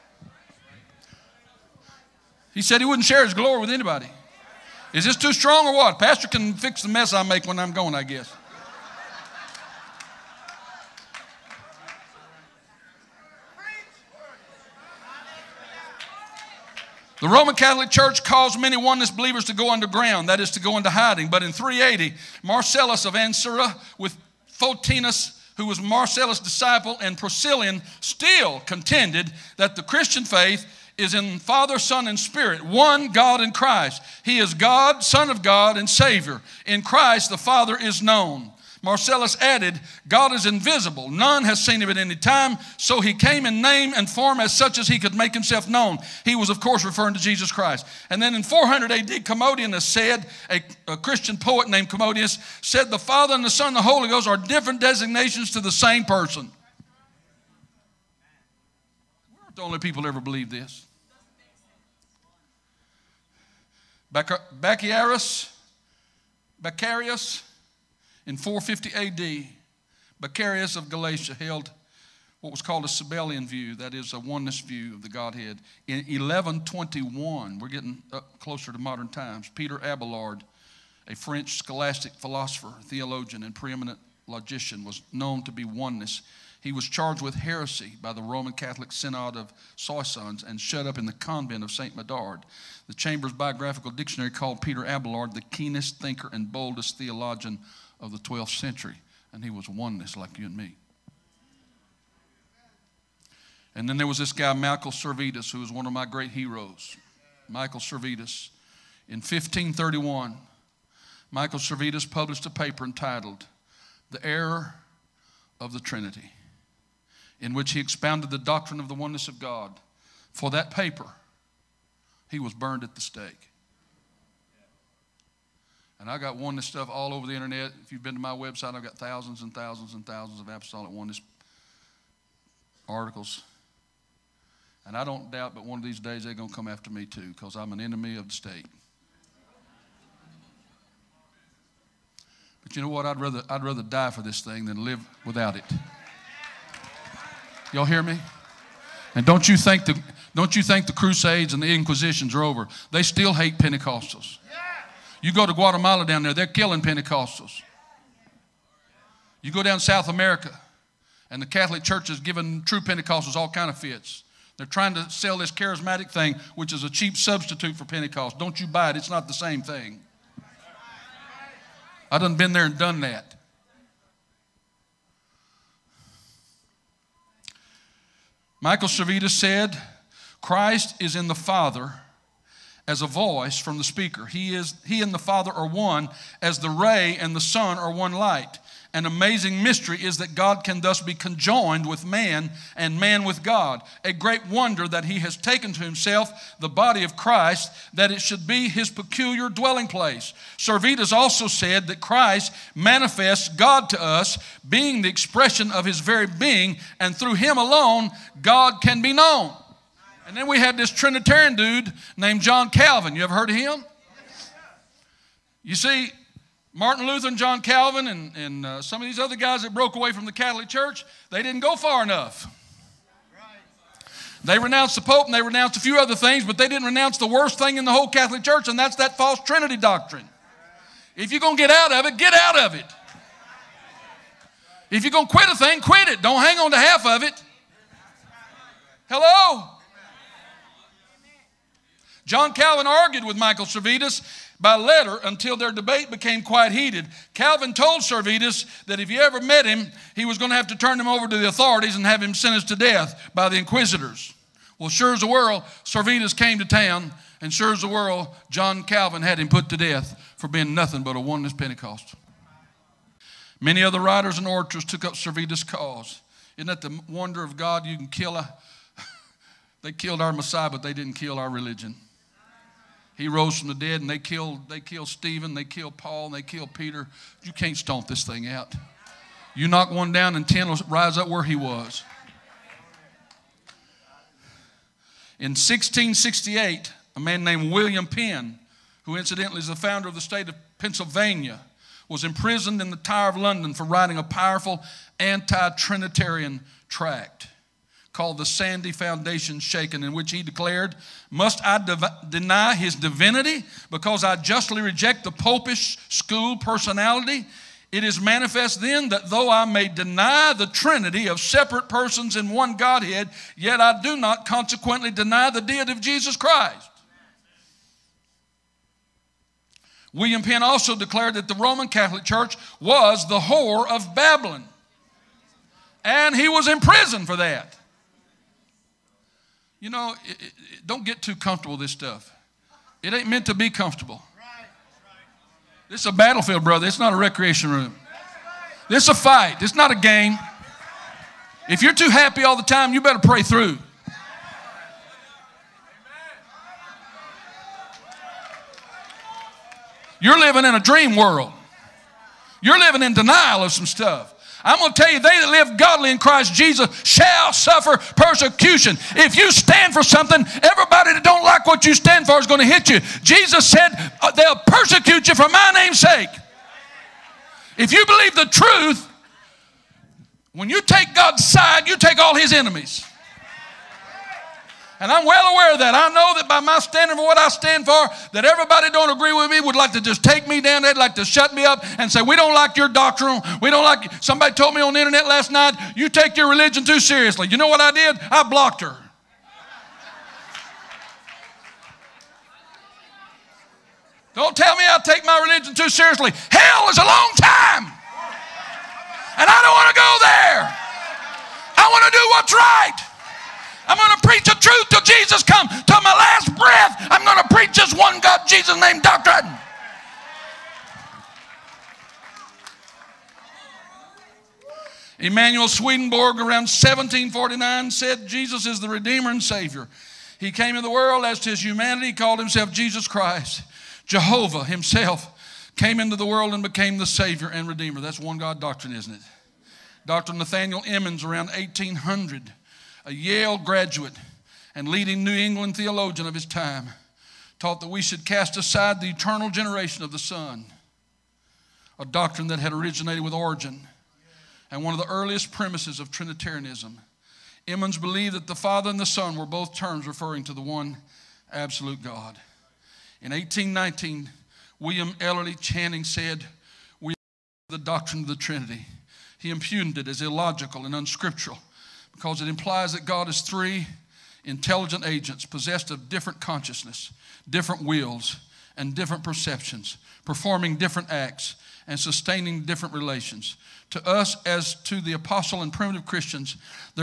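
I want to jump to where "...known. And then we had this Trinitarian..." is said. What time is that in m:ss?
3:29.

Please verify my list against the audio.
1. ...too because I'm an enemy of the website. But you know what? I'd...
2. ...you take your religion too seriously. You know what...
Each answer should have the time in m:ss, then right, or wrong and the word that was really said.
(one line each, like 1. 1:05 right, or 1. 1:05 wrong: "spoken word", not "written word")
1. 2:17 wrong: "state", not "website"
2. 6:25 right.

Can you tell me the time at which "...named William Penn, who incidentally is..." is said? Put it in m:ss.
4:47.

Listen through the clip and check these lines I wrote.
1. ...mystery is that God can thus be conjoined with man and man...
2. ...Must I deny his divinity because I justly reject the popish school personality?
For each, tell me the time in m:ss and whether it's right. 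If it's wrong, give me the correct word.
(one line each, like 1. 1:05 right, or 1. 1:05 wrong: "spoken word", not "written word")
1. 3:09 right
2. 5:01 right.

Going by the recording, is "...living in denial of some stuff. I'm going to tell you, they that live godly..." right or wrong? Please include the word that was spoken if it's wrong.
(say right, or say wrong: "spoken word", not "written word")
right.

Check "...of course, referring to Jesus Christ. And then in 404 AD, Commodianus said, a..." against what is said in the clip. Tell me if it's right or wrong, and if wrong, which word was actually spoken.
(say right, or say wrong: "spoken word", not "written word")
wrong: "400", not "404".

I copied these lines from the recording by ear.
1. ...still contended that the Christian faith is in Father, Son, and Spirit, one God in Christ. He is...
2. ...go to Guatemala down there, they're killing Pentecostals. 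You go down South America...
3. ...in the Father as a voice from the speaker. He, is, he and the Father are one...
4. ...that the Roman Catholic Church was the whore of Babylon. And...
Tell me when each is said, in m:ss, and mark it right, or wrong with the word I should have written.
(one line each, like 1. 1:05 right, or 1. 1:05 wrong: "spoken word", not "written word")
1. 0:27 right
2. 2:35 right
3. 3:01 right
4. 5:21 right.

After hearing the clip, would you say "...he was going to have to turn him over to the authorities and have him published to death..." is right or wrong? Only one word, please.
wrong.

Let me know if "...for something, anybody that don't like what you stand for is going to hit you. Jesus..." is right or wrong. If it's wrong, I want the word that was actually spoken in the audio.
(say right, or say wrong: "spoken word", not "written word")
wrong: "everybody", not "anybody".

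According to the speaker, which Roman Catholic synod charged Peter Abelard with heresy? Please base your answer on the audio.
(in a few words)
Synod of Soissons.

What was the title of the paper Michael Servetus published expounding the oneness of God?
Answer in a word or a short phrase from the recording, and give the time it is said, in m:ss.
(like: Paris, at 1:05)
The Error of the Trinity, at 1:54.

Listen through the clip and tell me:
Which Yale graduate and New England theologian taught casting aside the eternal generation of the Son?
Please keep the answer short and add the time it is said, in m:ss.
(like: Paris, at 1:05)
Nathaniel Emmons, at 7:10.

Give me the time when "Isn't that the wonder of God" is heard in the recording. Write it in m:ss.
4:26.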